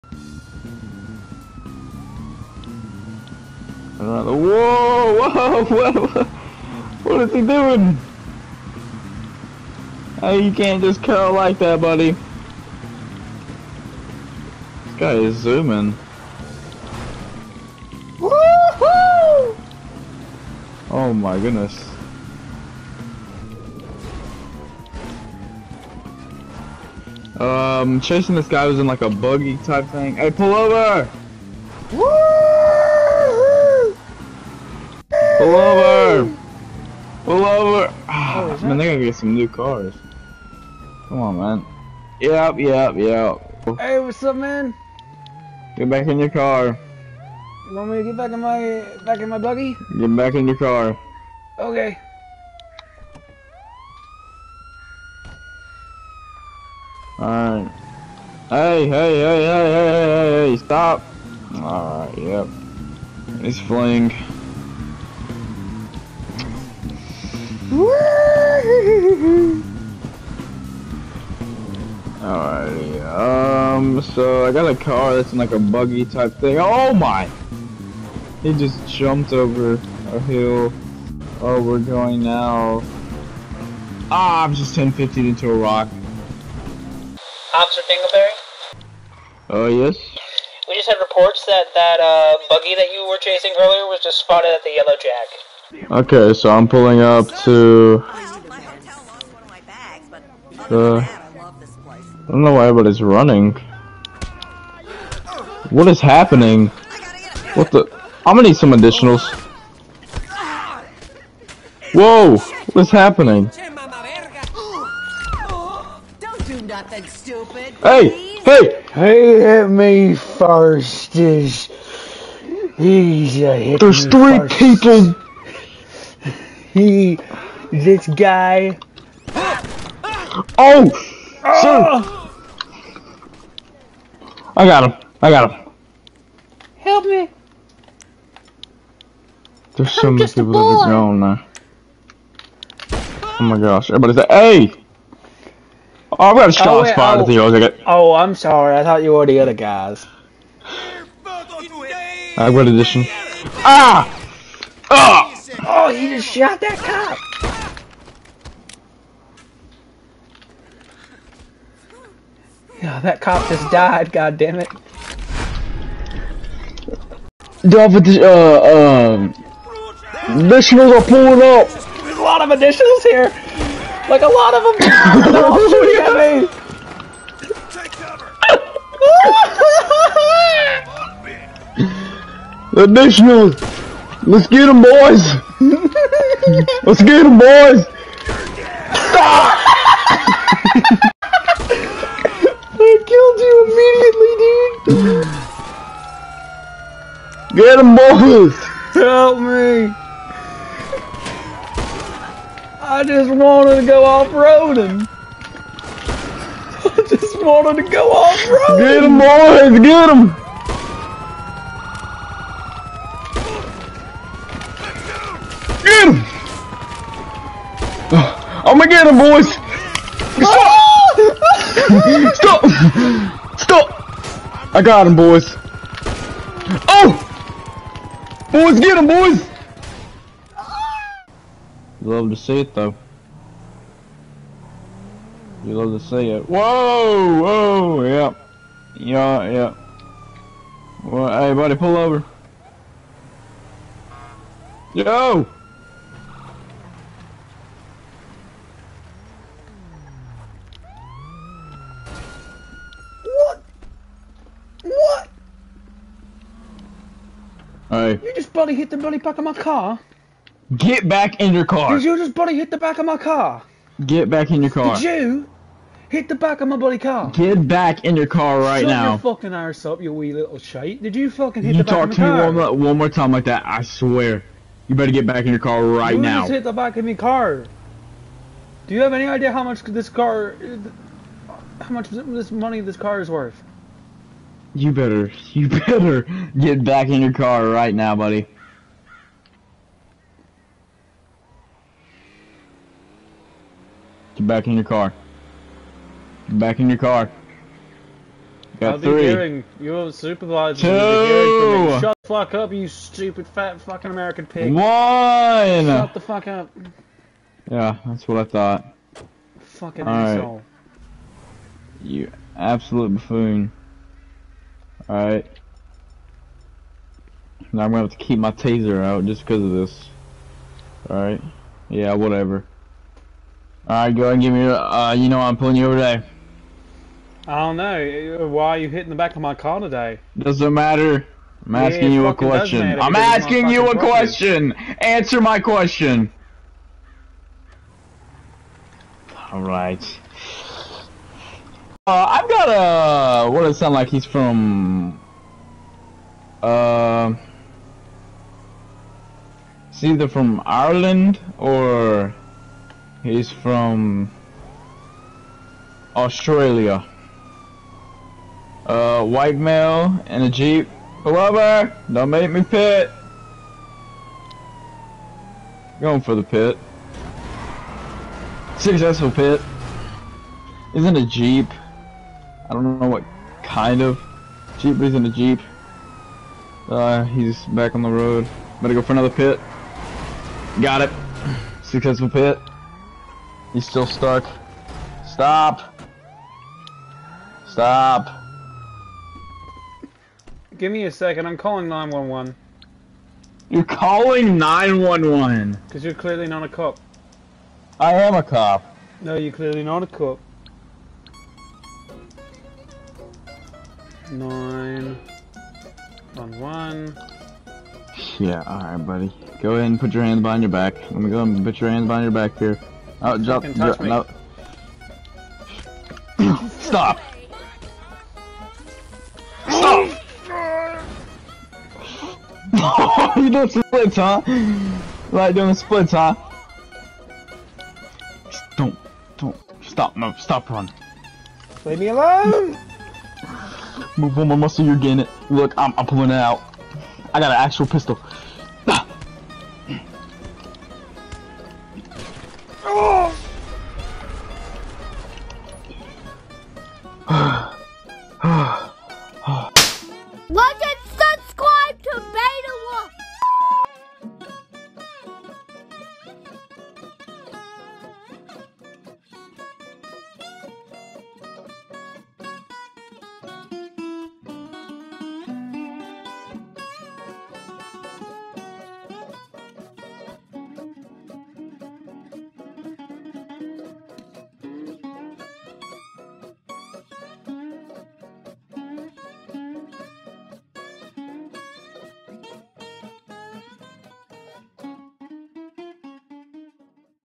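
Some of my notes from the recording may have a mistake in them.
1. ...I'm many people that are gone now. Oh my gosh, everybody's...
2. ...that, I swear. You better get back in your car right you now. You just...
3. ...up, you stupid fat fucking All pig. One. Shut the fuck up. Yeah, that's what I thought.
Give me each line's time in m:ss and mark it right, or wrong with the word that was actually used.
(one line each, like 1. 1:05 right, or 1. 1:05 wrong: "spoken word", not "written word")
1. 2:20 right
2. 4:33 right
3. 5:02 wrong: "American", not "All".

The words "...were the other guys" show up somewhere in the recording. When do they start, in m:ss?
2:29.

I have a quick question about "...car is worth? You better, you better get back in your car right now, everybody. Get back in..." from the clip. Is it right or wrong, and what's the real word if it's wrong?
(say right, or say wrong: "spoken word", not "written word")
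wrong: "buddy", not "everybody".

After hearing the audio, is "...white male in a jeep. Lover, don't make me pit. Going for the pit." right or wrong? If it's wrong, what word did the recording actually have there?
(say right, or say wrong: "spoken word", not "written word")
right.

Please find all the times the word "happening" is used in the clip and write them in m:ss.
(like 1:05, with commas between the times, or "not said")
1:46, 1:52.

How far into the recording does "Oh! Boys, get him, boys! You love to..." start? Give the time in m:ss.
3:46.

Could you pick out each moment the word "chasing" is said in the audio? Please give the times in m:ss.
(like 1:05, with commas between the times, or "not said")
0:28, 1:33.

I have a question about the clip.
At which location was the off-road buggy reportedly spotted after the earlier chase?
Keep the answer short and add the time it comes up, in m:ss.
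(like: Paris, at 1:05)
Yellow Jack, at 1:34.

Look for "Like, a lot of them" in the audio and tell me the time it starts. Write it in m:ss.
2:54.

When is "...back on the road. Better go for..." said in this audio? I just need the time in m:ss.
6:17.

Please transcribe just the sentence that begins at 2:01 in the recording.
Is a hit There's three first.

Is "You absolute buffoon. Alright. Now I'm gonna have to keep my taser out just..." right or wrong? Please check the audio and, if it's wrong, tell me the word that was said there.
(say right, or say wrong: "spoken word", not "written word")
right.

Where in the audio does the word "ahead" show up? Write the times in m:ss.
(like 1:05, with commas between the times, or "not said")
5:24, 6:49.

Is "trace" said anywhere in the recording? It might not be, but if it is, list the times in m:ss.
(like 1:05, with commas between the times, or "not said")
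not said.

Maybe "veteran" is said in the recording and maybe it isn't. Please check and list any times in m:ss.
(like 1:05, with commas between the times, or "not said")
not said.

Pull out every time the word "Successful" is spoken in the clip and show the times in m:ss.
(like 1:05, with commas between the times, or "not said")
6:08, 6:21.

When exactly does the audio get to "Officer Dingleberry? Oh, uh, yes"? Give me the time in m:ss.
1:27.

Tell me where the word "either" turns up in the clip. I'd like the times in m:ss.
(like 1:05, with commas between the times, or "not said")
5:50.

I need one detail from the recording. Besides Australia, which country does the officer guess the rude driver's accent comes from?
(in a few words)
Ireland.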